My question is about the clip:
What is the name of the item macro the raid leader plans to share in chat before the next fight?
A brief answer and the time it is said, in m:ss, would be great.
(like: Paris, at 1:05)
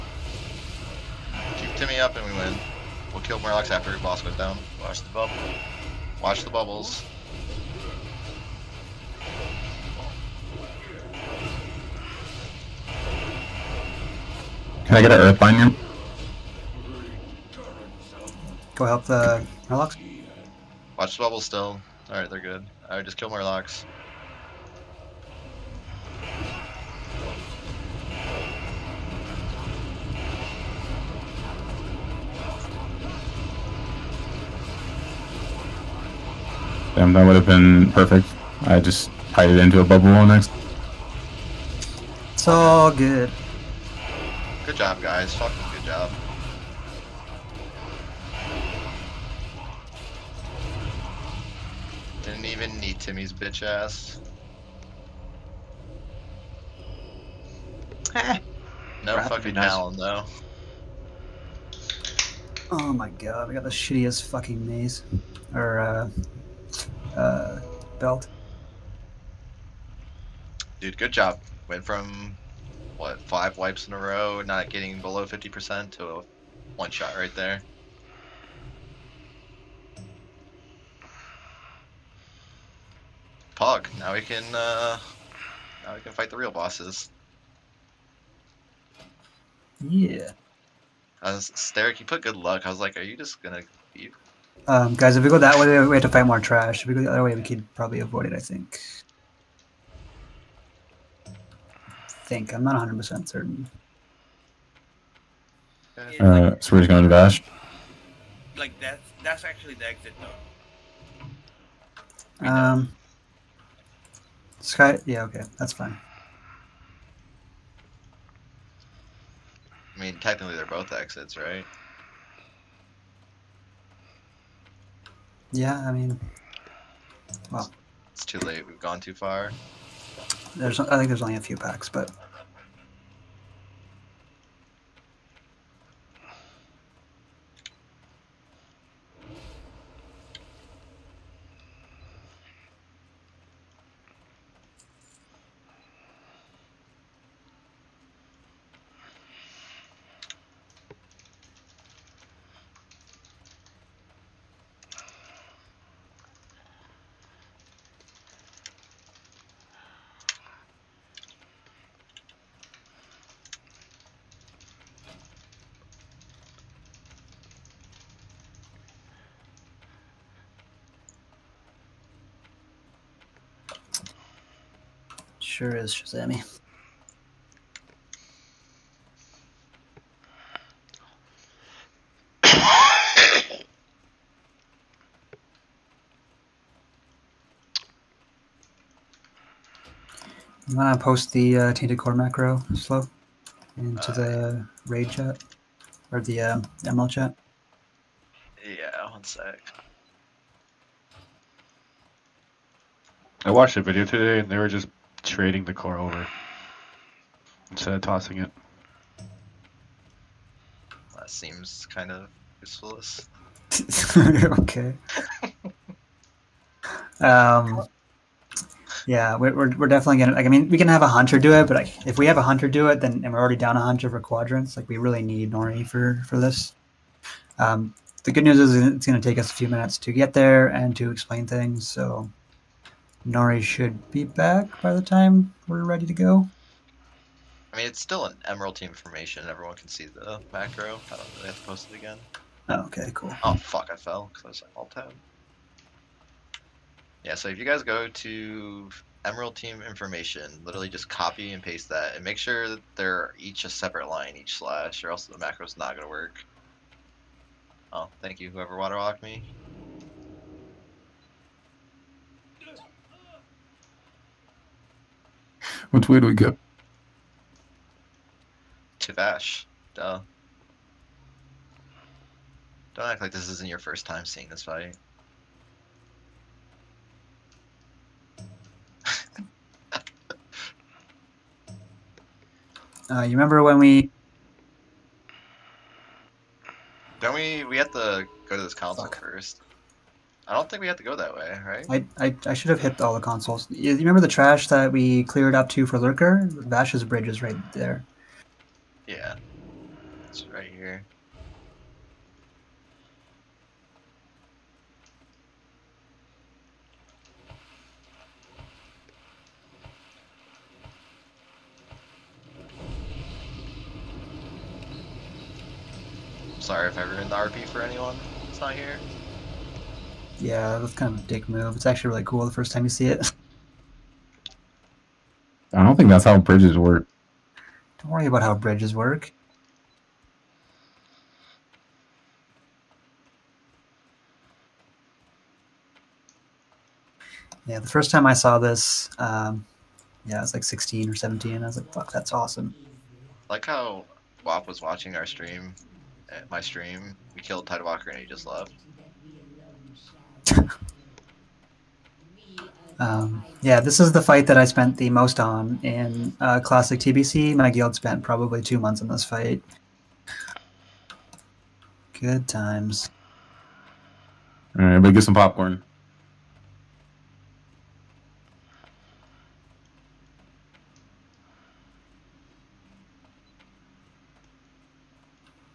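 Tainted Core, at 3:11.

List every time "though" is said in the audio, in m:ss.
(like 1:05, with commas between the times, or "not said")
0:59, 1:52.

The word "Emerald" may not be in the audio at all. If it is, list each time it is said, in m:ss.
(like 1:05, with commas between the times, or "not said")
3:58, 4:09.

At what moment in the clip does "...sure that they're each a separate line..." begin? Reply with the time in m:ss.
4:12.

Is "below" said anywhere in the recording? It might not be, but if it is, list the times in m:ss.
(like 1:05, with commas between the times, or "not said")
1:15.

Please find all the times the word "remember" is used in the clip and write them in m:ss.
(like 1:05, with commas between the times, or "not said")
4:43, 4:53.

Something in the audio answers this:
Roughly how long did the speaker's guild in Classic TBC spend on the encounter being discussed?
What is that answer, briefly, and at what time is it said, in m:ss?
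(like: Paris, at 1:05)
2 months, at 5:58.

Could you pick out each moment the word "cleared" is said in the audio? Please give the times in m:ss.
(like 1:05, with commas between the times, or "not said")
4:55.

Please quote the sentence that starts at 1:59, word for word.
I mean, technically they're both exits, right?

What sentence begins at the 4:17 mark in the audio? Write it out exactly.
Oh, thank you, whoever waterwalked me.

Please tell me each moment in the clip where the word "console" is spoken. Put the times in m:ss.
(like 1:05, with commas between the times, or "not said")
4:48, 4:53.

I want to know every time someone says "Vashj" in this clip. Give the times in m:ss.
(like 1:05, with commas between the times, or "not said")
4:29, 4:56.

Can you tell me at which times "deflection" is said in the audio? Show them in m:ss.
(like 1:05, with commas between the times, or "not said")
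not said.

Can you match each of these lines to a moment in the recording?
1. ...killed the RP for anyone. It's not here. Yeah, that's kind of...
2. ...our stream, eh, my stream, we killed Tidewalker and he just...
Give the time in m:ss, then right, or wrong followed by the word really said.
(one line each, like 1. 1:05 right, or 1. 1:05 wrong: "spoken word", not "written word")
1. 5:17 wrong: "ruined", not "killed"
2. 5:45 right.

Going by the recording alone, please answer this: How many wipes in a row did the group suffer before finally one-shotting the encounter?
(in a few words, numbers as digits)
5.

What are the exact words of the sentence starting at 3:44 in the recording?
Like, we really need Nori for for this.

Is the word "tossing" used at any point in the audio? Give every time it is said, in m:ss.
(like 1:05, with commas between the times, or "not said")
3:28.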